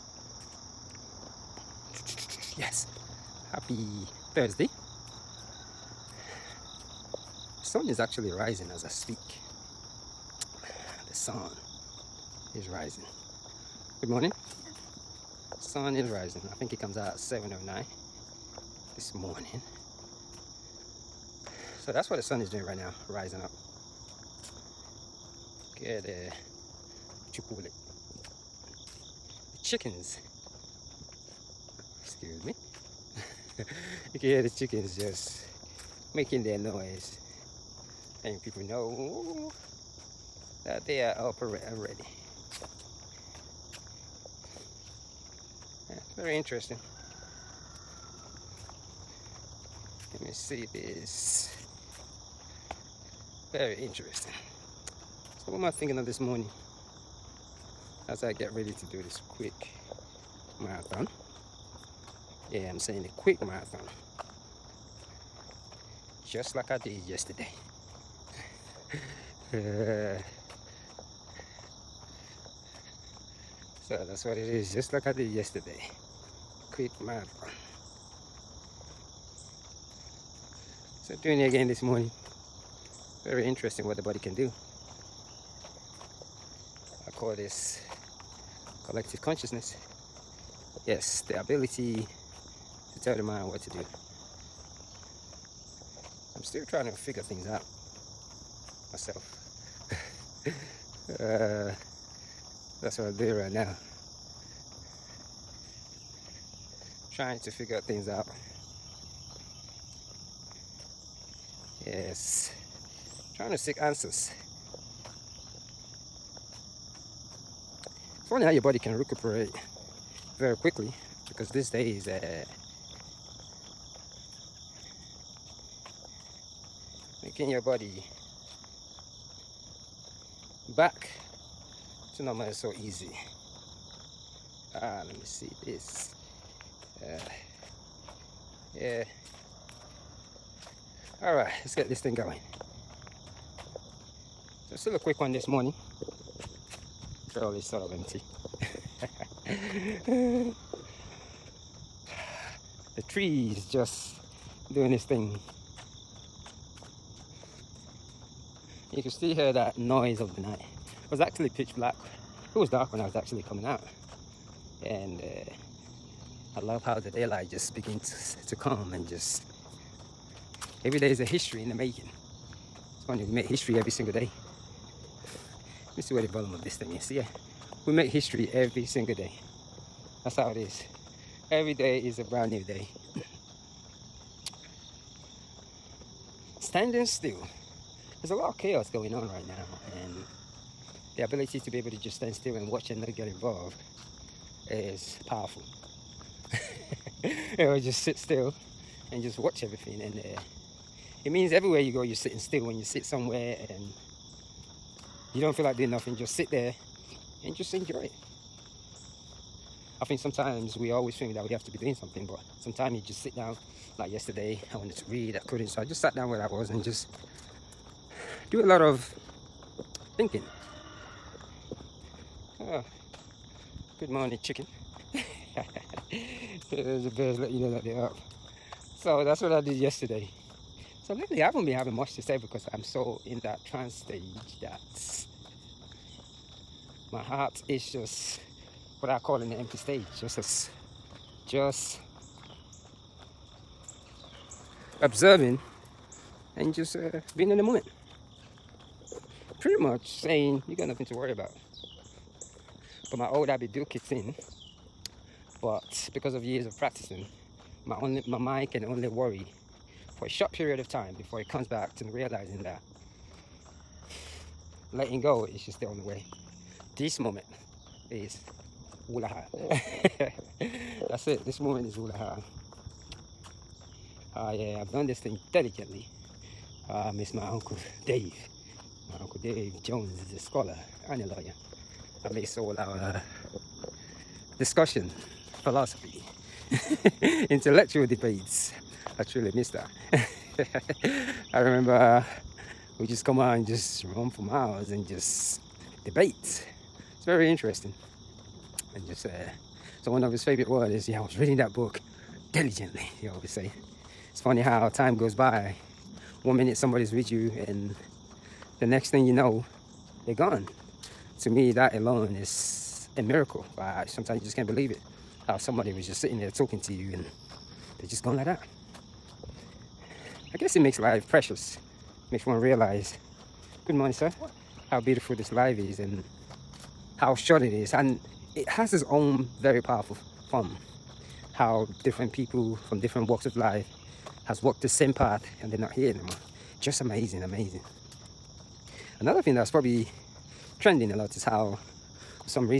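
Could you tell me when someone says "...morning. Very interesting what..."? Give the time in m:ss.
1:21.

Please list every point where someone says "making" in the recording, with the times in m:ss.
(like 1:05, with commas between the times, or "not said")
0:36, 2:07, 2:51.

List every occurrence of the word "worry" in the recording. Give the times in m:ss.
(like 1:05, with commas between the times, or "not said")
4:11, 4:19.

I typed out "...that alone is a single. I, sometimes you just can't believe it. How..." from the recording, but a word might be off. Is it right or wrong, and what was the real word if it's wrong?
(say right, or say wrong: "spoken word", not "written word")
wrong: "miracle", not "single".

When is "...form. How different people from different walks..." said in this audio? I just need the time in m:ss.
5:30.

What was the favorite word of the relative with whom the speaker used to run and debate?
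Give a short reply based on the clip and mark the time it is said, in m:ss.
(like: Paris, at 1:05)
diligently, at 5:02.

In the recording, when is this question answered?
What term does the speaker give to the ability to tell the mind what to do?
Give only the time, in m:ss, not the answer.
1:28.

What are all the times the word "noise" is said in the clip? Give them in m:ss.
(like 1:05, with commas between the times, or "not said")
0:36, 2:39.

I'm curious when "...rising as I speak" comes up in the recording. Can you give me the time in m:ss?
0:08.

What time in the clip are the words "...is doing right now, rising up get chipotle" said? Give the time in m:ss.
0:22.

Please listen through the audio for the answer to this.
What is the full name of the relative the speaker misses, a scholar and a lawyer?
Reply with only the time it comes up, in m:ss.
4:39.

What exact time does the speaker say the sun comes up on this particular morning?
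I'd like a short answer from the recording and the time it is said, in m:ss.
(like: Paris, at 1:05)
7:09, at 0:17.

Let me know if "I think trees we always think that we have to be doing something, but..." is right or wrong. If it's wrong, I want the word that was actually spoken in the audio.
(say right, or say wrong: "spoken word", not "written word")
wrong: "sometimes", not "trees".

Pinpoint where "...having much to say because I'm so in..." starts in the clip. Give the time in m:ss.
3:51.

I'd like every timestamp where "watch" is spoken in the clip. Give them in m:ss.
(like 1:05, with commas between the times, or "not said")
3:12, 3:19.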